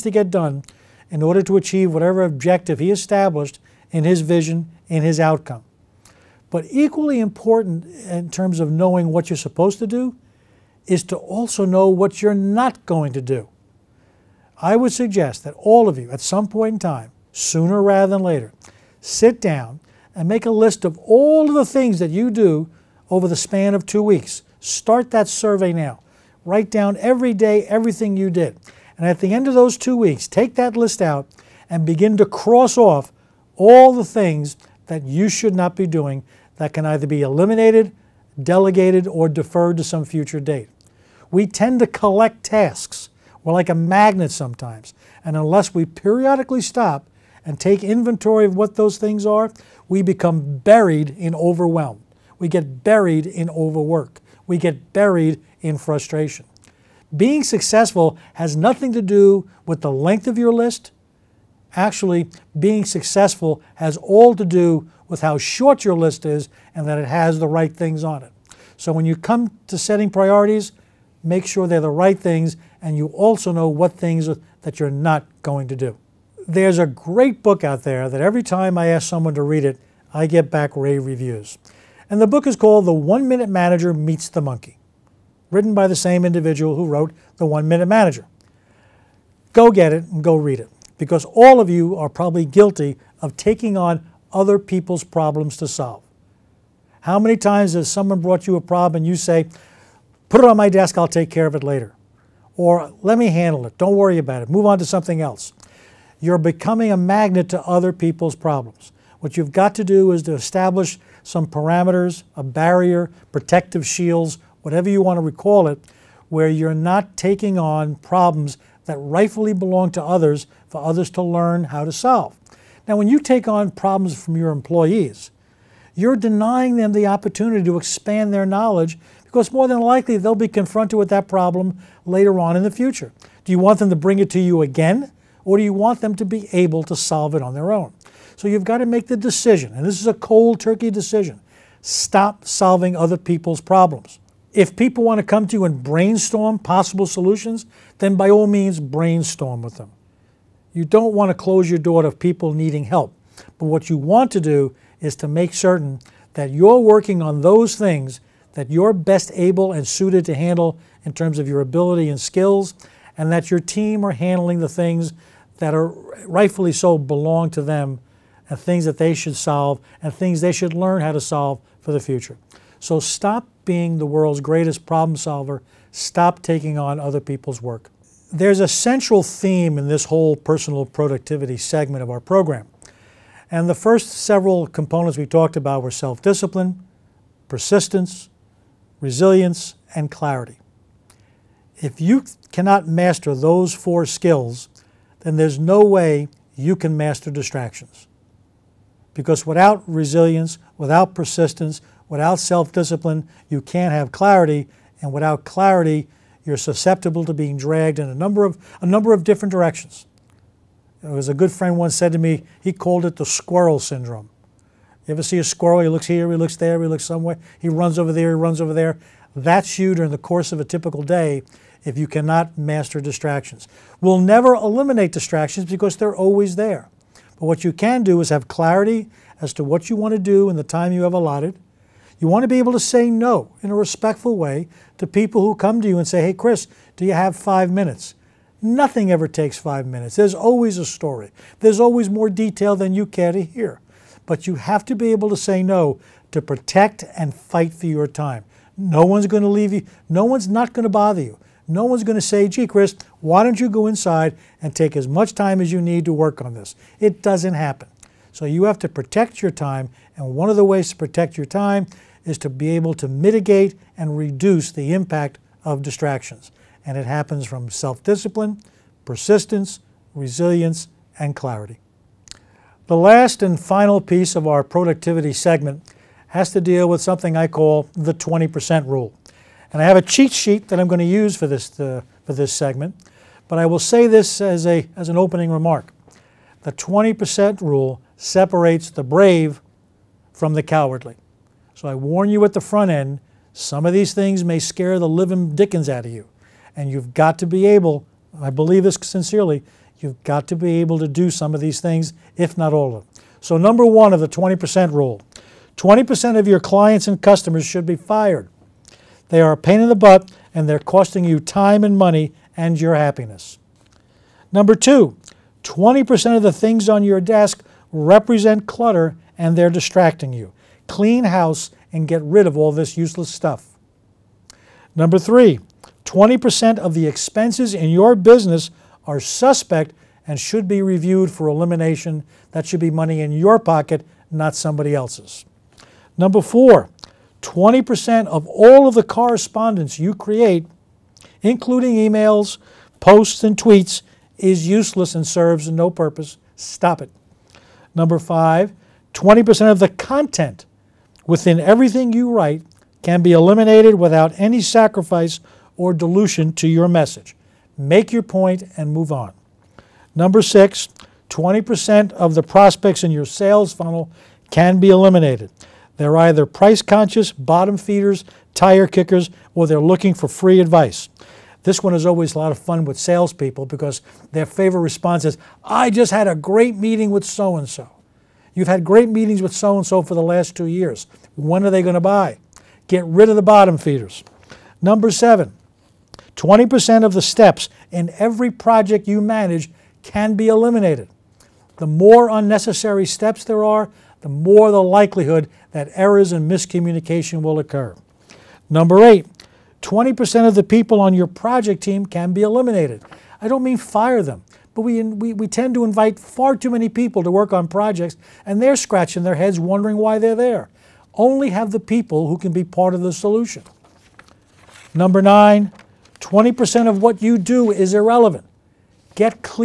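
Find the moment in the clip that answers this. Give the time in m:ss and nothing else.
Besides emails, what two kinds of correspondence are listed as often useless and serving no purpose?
5:43.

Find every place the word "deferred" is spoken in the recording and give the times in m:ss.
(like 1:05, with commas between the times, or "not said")
0:39.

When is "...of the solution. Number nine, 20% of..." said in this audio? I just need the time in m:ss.
6:52.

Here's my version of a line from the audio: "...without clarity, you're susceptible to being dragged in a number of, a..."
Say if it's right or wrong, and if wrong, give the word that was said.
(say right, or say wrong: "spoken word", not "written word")
right.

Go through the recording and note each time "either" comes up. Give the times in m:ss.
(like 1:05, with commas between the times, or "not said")
0:36, 6:06.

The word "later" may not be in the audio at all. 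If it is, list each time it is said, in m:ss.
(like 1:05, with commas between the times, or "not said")
0:18, 1:41, 2:12.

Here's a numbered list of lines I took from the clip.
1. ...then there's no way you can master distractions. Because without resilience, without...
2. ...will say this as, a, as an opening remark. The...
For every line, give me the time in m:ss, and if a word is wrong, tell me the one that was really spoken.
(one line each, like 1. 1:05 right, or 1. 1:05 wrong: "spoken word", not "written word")
1. 3:15 right
2. 4:43 right.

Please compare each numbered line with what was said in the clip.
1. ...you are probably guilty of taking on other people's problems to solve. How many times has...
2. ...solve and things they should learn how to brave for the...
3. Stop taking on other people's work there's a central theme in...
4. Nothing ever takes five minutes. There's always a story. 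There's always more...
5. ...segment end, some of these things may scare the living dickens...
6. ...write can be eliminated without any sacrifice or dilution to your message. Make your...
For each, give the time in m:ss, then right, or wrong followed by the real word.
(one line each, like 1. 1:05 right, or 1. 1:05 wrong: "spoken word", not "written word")
1. 1:31 right
2. 2:49 wrong: "solve", not "brave"
3. 2:55 right
4. 3:58 right
5. 4:52 wrong: "front", not "segment"
6. 5:52 right.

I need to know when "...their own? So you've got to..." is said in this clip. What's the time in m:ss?
2:17.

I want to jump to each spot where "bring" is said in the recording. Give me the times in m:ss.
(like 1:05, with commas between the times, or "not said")
2:13.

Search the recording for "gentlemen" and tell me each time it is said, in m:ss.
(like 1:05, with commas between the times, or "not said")
not said.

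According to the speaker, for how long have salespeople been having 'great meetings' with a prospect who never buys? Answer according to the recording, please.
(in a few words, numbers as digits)
2 years.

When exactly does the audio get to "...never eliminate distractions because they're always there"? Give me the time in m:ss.
3:44.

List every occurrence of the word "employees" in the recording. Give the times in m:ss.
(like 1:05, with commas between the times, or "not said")
2:04.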